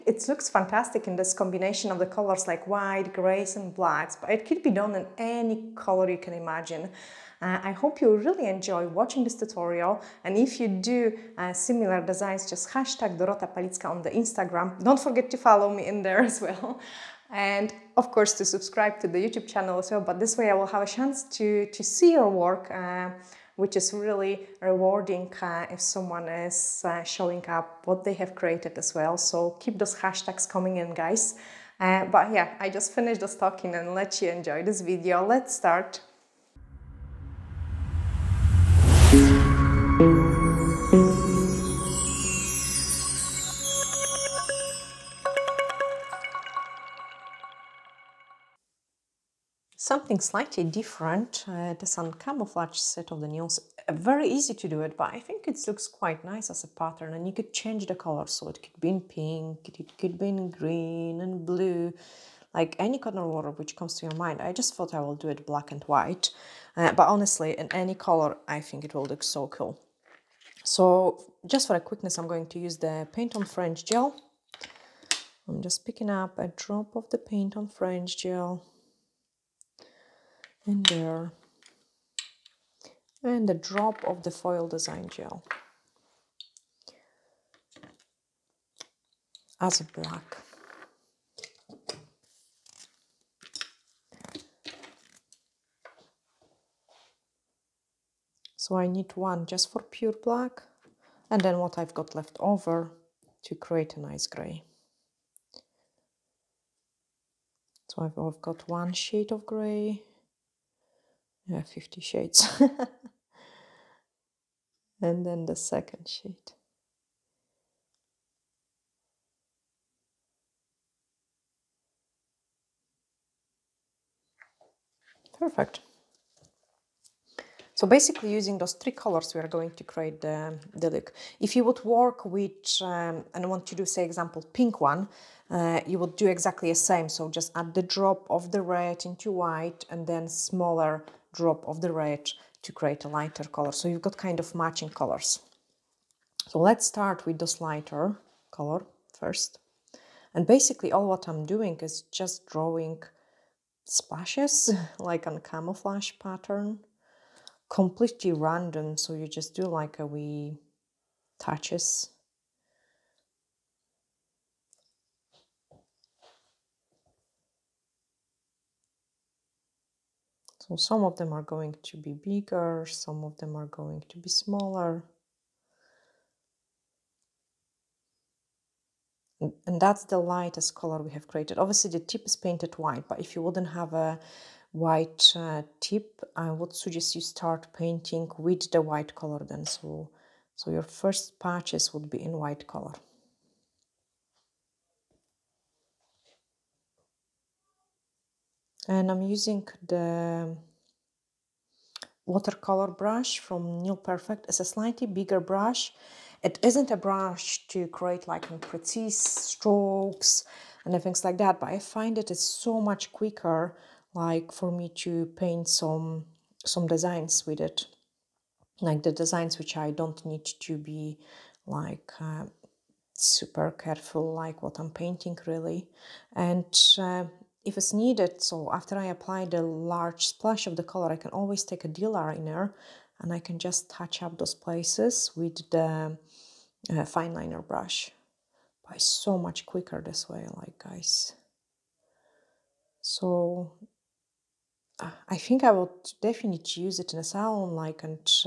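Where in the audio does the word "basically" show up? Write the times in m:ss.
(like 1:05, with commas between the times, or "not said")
2:07, 2:30.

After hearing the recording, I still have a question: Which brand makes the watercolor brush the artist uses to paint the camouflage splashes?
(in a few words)
Nail Perfect.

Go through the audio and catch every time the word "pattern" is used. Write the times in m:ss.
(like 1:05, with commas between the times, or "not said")
0:56, 2:36.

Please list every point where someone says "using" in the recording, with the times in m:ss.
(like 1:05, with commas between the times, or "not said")
2:08, 3:19.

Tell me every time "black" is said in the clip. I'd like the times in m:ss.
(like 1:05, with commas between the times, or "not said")
0:03, 1:05, 1:29, 1:40.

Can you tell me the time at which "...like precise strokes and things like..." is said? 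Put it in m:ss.
3:28.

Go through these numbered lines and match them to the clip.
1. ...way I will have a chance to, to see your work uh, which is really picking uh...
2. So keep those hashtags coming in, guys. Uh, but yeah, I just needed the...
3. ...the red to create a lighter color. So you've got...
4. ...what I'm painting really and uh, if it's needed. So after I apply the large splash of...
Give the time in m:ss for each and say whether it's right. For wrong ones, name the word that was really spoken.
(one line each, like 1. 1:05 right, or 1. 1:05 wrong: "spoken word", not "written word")
1. 0:20 wrong: "rewarding", not "picking"
2. 0:29 wrong: "finished", not "needed"
3. 2:21 right
4. 3:44 right.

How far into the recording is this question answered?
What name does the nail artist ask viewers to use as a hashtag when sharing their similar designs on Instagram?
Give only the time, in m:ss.
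0:13.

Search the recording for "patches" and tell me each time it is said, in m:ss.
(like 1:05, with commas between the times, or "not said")
3:11.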